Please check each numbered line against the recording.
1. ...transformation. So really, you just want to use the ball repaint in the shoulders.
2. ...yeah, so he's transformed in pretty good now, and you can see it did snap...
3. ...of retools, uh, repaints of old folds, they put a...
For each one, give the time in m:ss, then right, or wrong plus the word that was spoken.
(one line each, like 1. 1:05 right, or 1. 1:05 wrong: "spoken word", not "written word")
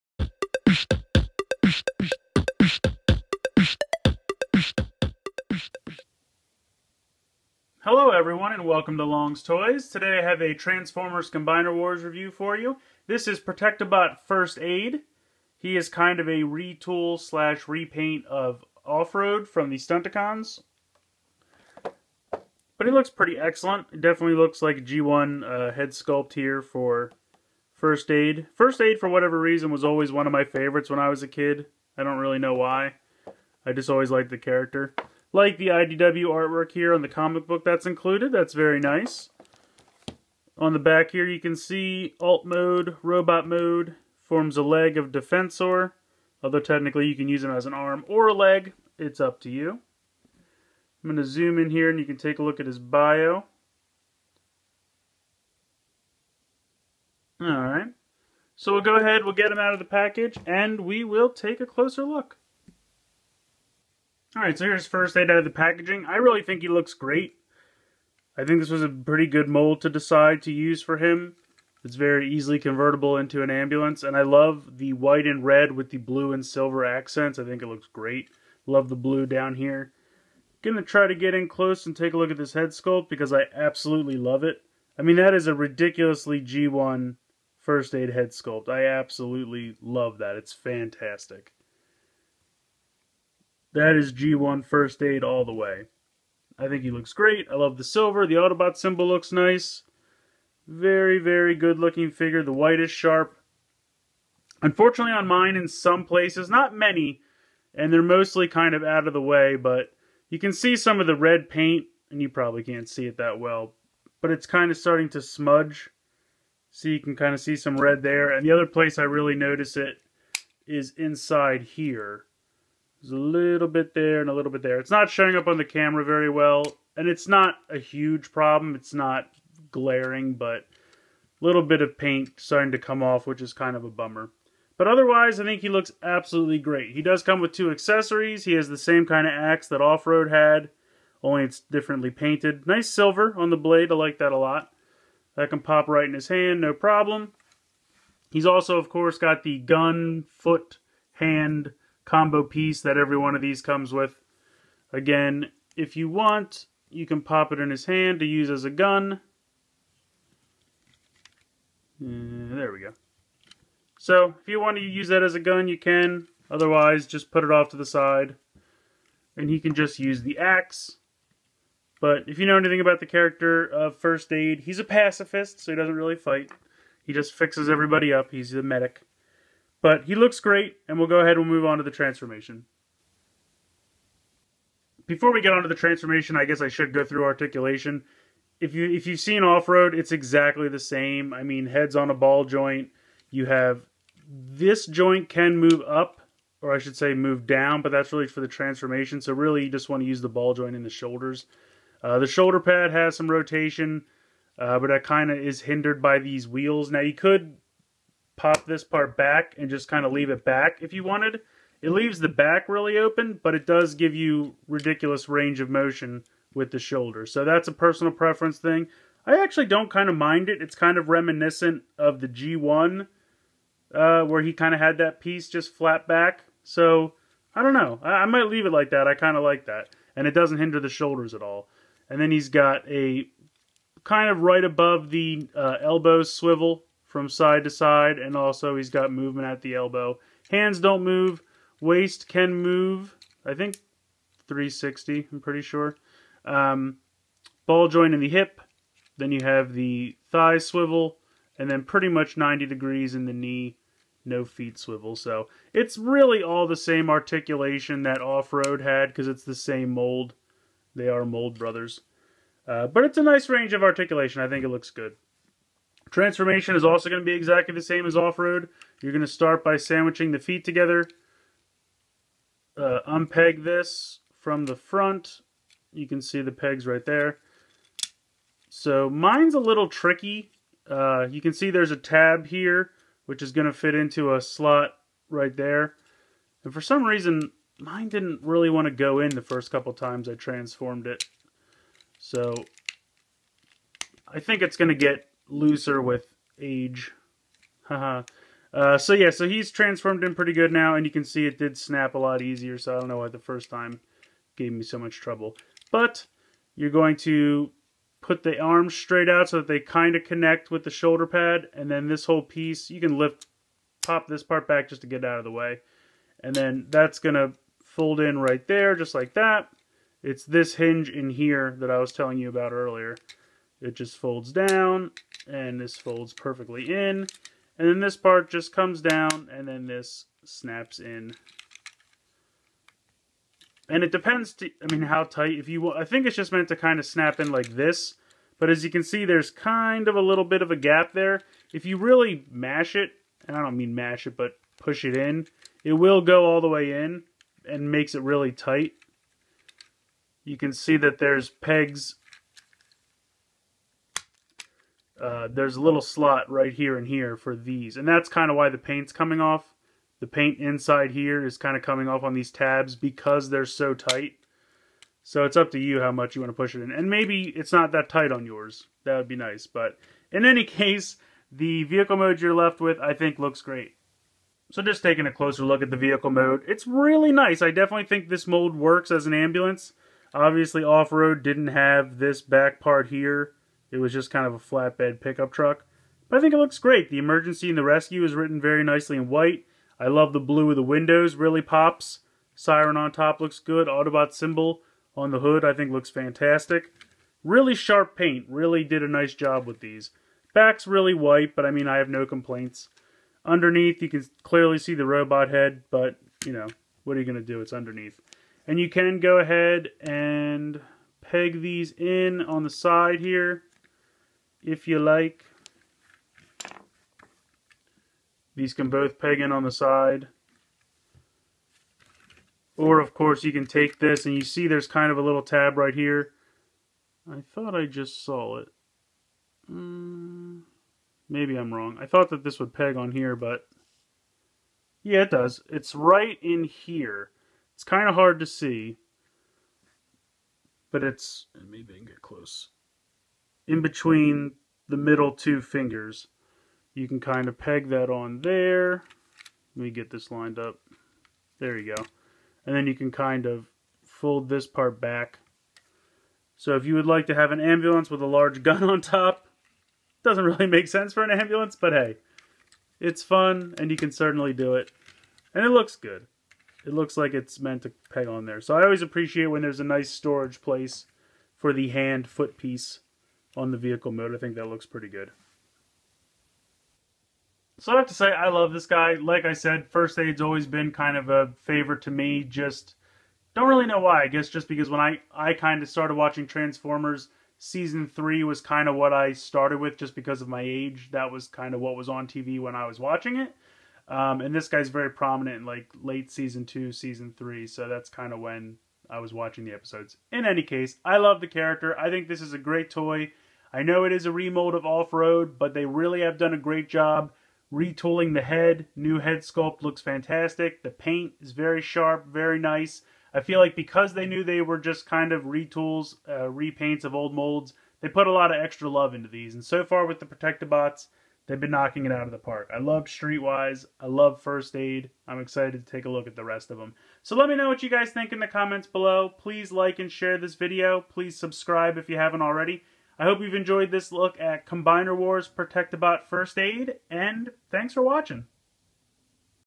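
1. 3:18 wrong: "joint", not "repaint"
2. 4:59 right
3. 8:35 wrong: "molds", not "folds".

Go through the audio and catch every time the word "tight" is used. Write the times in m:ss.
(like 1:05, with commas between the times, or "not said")
5:35, 5:48, 6:03, 6:08.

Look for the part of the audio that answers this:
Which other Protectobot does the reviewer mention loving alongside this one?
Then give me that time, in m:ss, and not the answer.
8:43.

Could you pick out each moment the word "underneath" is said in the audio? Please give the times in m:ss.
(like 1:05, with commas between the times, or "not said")
6:43, 6:47.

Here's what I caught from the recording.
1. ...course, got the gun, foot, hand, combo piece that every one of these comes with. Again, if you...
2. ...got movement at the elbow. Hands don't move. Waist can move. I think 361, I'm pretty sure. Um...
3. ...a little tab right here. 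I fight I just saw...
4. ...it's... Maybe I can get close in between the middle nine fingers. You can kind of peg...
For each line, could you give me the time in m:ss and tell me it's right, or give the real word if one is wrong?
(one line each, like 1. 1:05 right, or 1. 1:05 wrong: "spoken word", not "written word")
1. 2:28 right
2. 3:58 wrong: "360", not "361"
3. 7:05 wrong: "thought", not "fight"
4. 7:21 wrong: "two", not "nine".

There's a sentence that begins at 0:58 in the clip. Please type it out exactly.
So we'll go ahead, we'll get him out of the package, and we will take a closer look.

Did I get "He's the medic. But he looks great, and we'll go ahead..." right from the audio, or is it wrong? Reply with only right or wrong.
right.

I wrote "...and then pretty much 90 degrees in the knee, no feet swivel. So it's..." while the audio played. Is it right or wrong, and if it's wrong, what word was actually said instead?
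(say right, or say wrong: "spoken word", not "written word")
right.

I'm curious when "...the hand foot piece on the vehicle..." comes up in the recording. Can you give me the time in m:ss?
7:51.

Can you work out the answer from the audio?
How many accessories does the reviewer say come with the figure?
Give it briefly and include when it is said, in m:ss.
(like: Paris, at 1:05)
2, at 2:17.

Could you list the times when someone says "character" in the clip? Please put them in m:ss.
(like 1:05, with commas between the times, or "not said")
0:34, 2:53, 8:21.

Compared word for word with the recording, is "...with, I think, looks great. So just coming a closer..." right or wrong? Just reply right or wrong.
wrong.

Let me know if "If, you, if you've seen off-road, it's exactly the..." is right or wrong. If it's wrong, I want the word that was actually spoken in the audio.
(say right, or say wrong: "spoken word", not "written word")
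right.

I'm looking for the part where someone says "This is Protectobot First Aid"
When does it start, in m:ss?
0:13.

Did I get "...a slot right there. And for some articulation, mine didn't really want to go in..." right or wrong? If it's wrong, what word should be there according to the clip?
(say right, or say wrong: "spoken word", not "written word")
wrong: "reason", not "articulation".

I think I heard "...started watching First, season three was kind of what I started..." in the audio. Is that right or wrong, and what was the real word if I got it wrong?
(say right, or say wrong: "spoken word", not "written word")
wrong: "Transformers", not "First".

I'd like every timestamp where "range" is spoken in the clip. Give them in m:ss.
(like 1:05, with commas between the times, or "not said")
3:35, 4:23.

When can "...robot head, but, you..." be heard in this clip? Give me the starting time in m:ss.
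6:45.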